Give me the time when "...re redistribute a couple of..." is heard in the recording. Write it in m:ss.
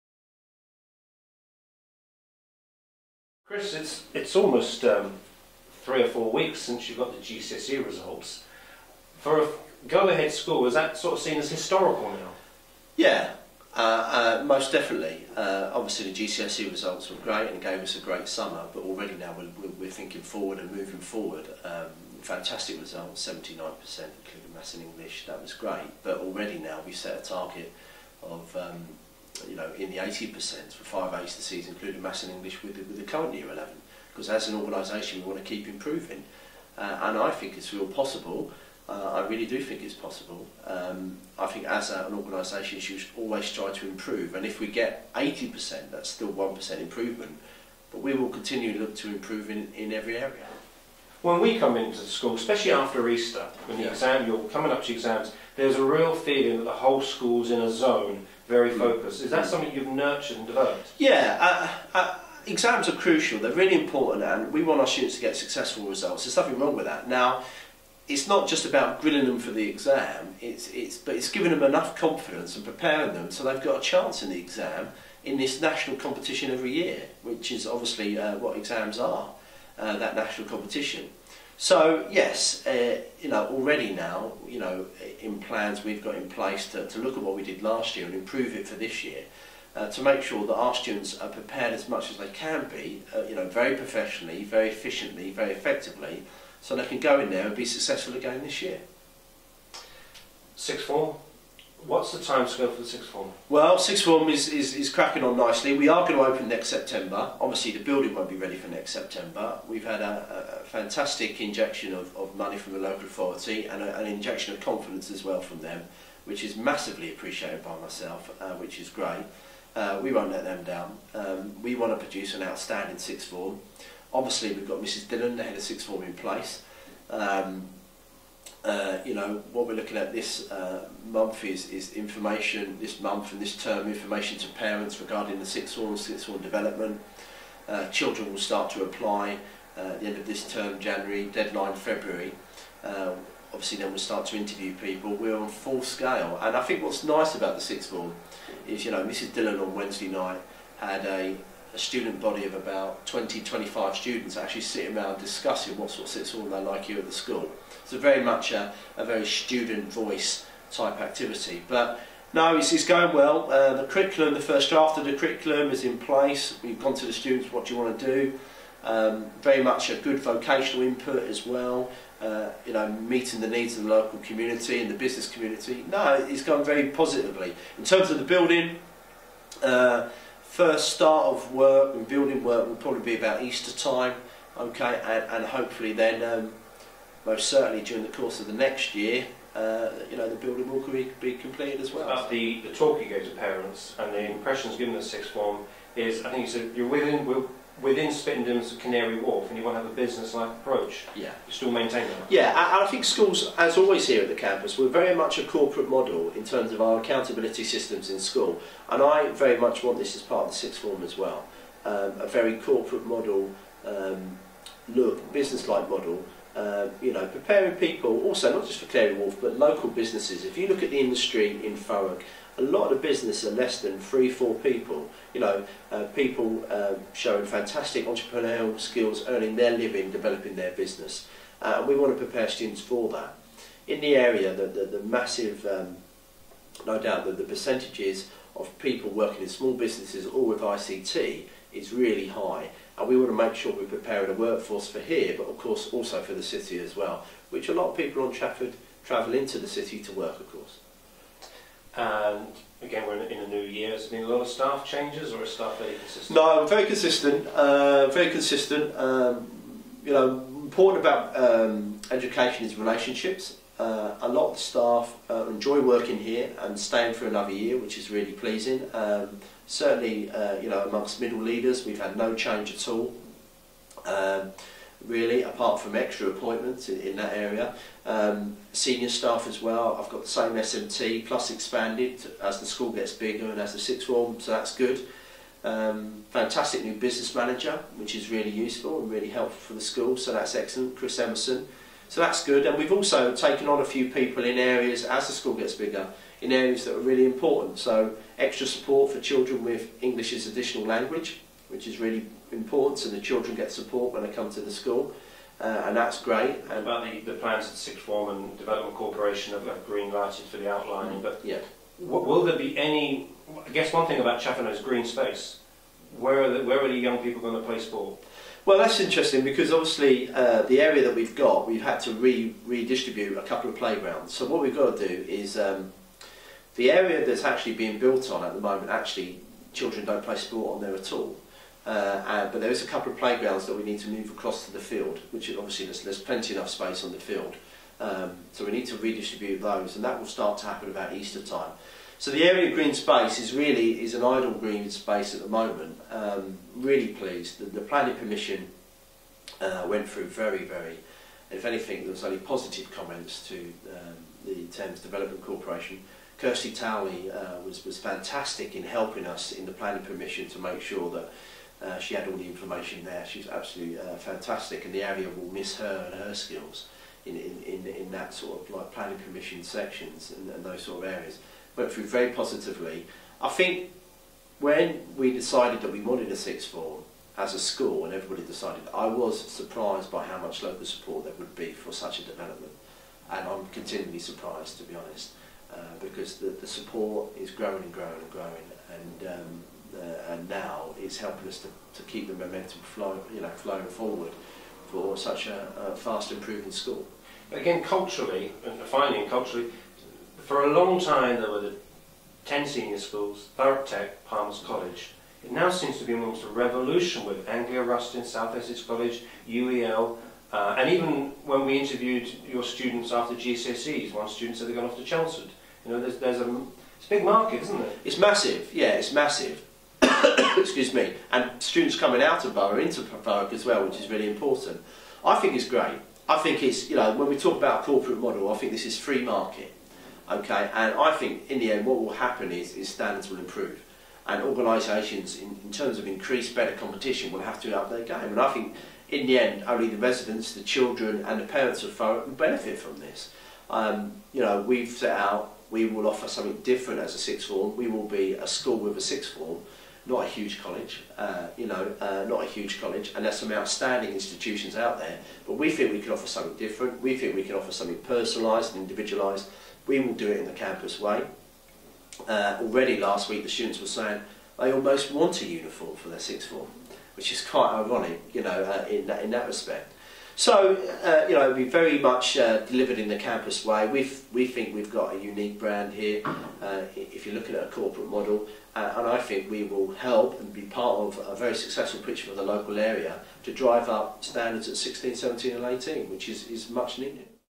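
5:22.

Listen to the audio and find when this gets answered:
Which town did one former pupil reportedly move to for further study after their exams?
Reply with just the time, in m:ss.
6:55.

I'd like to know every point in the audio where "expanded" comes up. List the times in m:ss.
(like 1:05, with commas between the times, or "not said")
4:41.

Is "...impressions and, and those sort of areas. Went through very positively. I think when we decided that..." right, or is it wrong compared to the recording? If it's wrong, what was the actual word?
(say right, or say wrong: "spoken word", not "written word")
wrong: "sections", not "impressions".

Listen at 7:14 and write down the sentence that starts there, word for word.
And organisations, in, in terms of increased, better competition, will have to up their game.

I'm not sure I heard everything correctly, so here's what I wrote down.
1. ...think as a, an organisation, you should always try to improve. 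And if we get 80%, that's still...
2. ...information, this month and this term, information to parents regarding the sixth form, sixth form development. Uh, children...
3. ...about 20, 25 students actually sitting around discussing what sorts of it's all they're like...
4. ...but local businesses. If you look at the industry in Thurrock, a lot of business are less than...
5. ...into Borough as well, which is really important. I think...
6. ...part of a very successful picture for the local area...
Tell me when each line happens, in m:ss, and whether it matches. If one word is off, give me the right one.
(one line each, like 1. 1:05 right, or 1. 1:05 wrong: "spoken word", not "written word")
1. 0:41 right
2. 2:11 right
3. 2:32 right
4. 3:39 right
5. 7:02 right
6. 8:00 right.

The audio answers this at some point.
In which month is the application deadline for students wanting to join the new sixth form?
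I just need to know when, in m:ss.
2:21.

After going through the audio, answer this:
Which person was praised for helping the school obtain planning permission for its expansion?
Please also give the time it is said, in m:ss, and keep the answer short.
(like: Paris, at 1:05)
Kirsty Towley, at 5:56.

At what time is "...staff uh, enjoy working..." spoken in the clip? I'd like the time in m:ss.
4:24.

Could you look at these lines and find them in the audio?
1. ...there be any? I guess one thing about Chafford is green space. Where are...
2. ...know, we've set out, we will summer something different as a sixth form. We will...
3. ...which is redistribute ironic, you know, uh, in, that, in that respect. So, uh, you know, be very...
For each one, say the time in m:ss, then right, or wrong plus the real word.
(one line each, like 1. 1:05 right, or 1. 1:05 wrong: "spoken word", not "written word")
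1. 5:12 right
2. 7:24 wrong: "offer", not "summer"
3. 7:47 wrong: "quite", not "redistribute".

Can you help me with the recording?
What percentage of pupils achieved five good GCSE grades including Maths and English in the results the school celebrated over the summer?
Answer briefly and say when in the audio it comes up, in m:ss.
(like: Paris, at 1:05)
79%, at 0:23.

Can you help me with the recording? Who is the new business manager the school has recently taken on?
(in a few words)
Chris Emerson.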